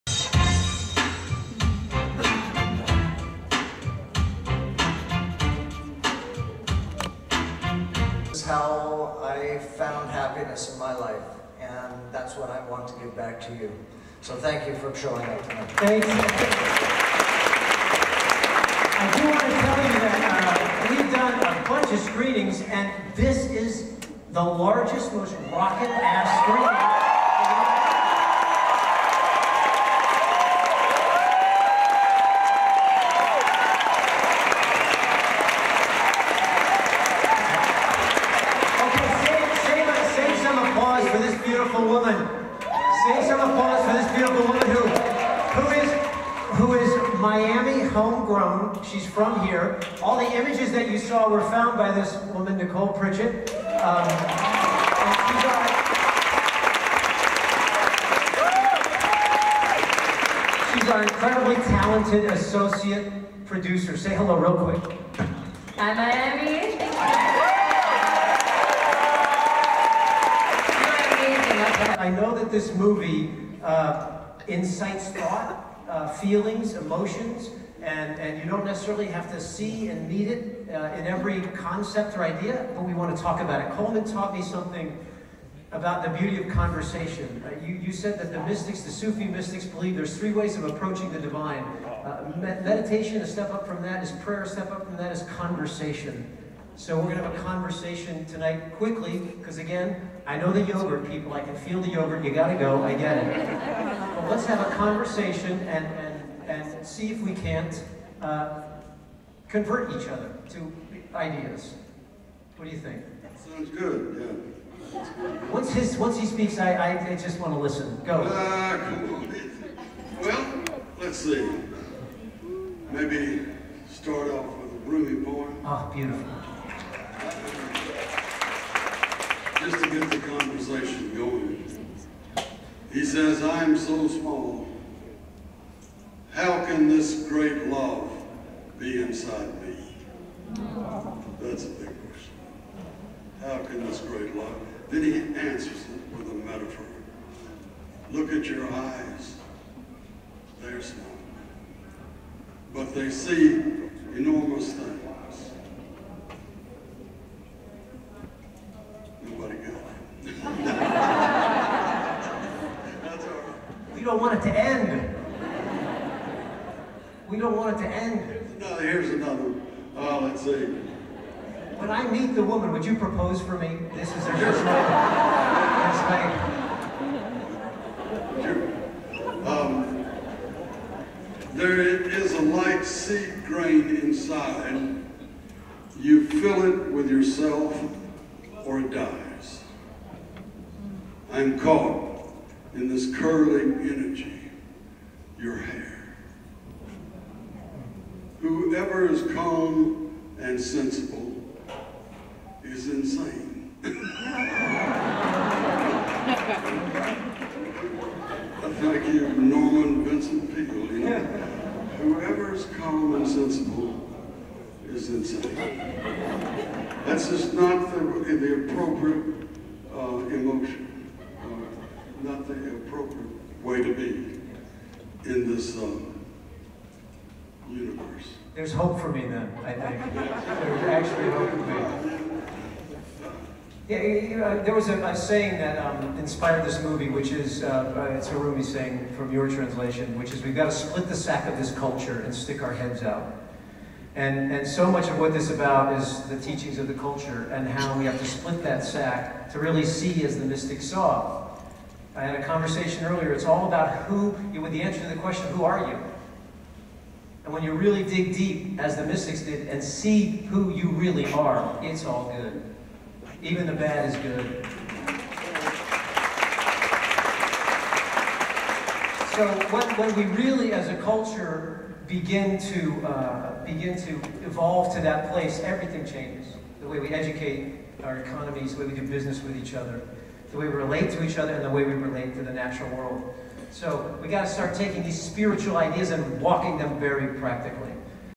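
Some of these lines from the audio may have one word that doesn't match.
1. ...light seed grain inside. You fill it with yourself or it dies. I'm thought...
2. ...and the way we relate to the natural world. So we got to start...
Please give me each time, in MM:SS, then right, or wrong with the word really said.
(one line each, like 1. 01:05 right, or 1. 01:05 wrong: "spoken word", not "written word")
1. 03:02 wrong: "caught", not "thought"
2. 04:41 right.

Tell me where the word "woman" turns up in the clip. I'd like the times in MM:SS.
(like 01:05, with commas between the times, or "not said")
00:52, 02:52.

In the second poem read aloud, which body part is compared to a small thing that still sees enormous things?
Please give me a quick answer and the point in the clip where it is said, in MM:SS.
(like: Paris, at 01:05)
Eyes, at 02:28.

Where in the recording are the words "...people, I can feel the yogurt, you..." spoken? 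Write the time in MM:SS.
01:41.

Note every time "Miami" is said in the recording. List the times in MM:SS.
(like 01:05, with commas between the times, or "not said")
00:47, 01:05.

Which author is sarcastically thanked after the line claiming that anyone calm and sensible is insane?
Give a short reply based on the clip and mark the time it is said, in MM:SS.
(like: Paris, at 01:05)
Norman Vincent Peale, at 03:29.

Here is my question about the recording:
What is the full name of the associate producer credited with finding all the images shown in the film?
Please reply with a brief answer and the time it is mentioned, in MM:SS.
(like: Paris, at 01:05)
Nicole Pritchett, at 00:52.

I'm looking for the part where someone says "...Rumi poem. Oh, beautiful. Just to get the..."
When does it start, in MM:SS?
02:04.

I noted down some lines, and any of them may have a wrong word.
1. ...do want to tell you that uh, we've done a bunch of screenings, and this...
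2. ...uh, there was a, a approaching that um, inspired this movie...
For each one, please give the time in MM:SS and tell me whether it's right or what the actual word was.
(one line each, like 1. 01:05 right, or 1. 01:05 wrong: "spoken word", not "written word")
1. 00:19 right
2. 03:54 wrong: "saying", not "approaching".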